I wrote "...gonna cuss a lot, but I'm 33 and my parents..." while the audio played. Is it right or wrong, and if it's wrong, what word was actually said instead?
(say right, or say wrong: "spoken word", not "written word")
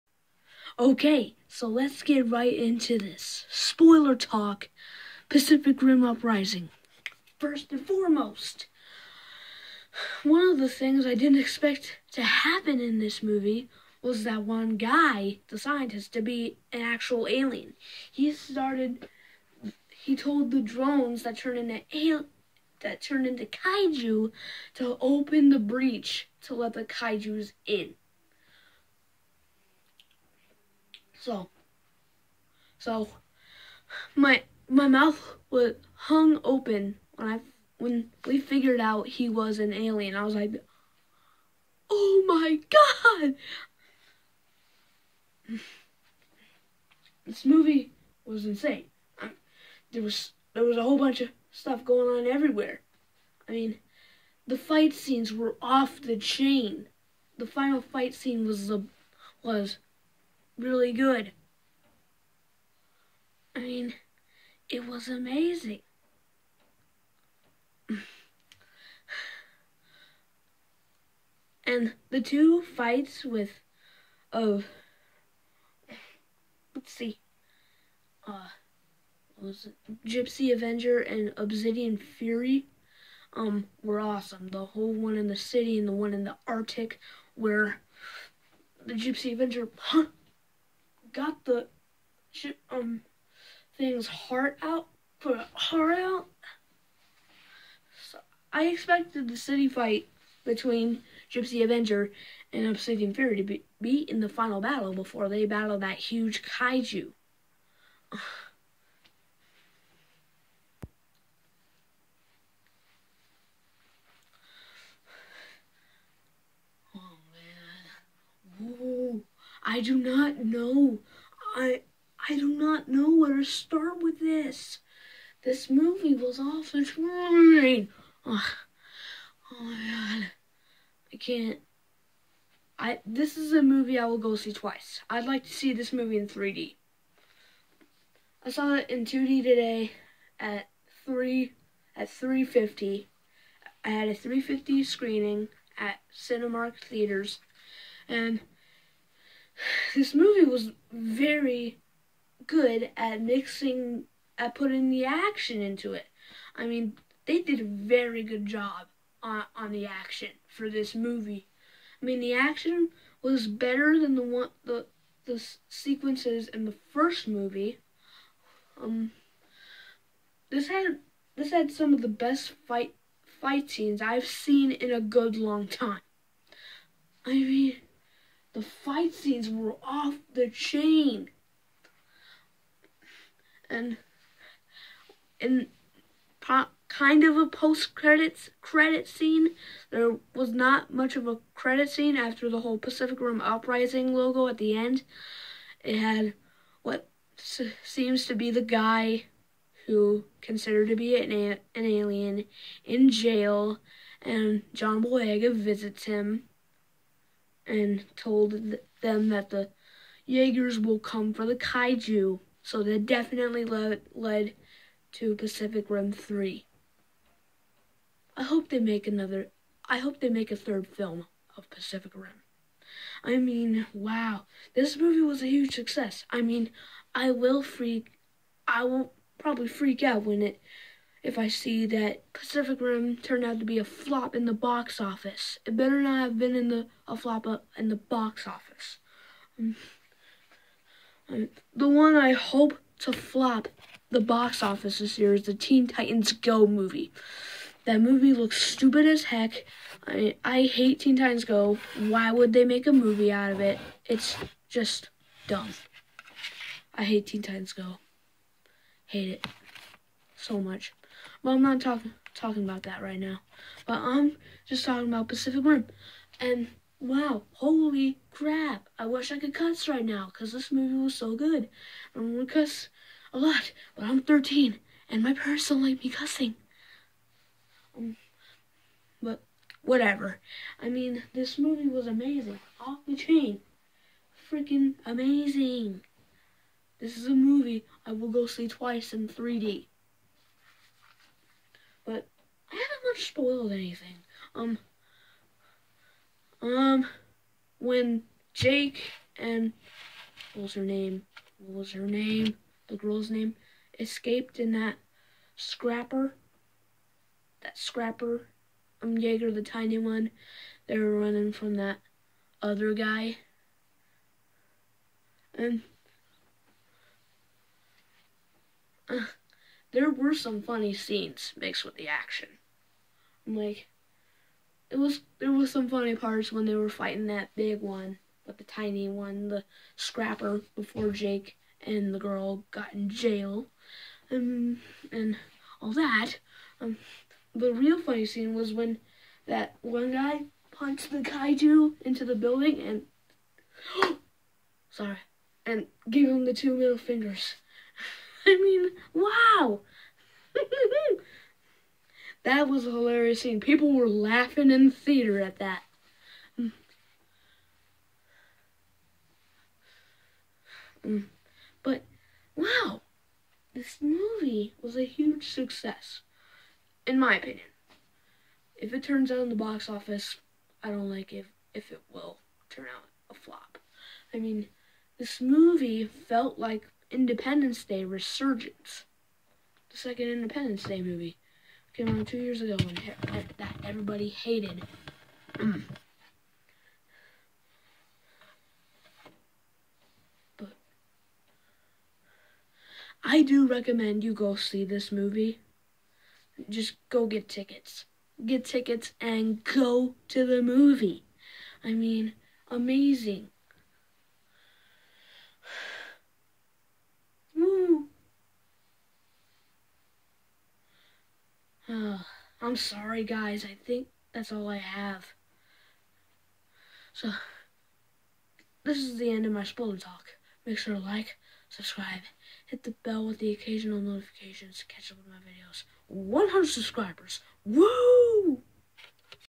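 wrong: "13", not "33".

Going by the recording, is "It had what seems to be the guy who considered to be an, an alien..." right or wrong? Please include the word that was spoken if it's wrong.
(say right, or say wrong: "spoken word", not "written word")
right.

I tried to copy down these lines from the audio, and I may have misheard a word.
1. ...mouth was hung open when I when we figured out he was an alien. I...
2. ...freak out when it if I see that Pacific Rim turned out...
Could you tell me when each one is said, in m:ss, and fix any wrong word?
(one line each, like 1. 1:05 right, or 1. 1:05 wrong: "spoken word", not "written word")
1. 0:34 right
2. 3:49 right.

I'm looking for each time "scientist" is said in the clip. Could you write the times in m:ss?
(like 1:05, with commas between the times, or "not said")
0:15.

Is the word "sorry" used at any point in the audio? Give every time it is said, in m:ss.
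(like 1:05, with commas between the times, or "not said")
5:44, 6:52.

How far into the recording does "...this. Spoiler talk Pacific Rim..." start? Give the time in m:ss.
0:02.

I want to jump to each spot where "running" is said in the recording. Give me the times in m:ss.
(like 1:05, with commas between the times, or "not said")
5:11.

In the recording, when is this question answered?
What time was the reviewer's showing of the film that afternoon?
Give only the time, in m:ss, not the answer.
2:24.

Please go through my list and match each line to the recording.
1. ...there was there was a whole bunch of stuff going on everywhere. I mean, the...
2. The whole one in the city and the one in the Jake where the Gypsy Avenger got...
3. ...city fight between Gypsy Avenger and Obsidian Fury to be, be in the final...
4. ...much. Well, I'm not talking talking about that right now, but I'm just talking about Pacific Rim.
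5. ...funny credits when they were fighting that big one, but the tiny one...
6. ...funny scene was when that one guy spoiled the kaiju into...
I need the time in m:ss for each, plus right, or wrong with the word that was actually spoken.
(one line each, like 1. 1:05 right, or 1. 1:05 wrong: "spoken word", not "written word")
1. 0:49 right
2. 1:24 wrong: "Arctic", not "Jake"
3. 1:39 right
4. 4:20 right
5. 5:25 wrong: "parts", not "credits"
6. 5:37 wrong: "punched", not "spoiled".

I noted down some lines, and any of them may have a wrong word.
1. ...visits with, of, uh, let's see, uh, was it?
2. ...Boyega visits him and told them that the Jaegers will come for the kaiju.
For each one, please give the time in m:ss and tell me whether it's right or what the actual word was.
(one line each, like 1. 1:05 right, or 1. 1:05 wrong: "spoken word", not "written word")
1. 1:12 wrong: "fights", not "visits"
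2. 3:25 right.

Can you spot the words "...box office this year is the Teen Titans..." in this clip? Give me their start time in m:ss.
4:04.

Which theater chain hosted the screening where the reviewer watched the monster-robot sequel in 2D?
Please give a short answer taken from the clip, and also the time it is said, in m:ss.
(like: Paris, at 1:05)
Cinemark Theaters, at 2:26.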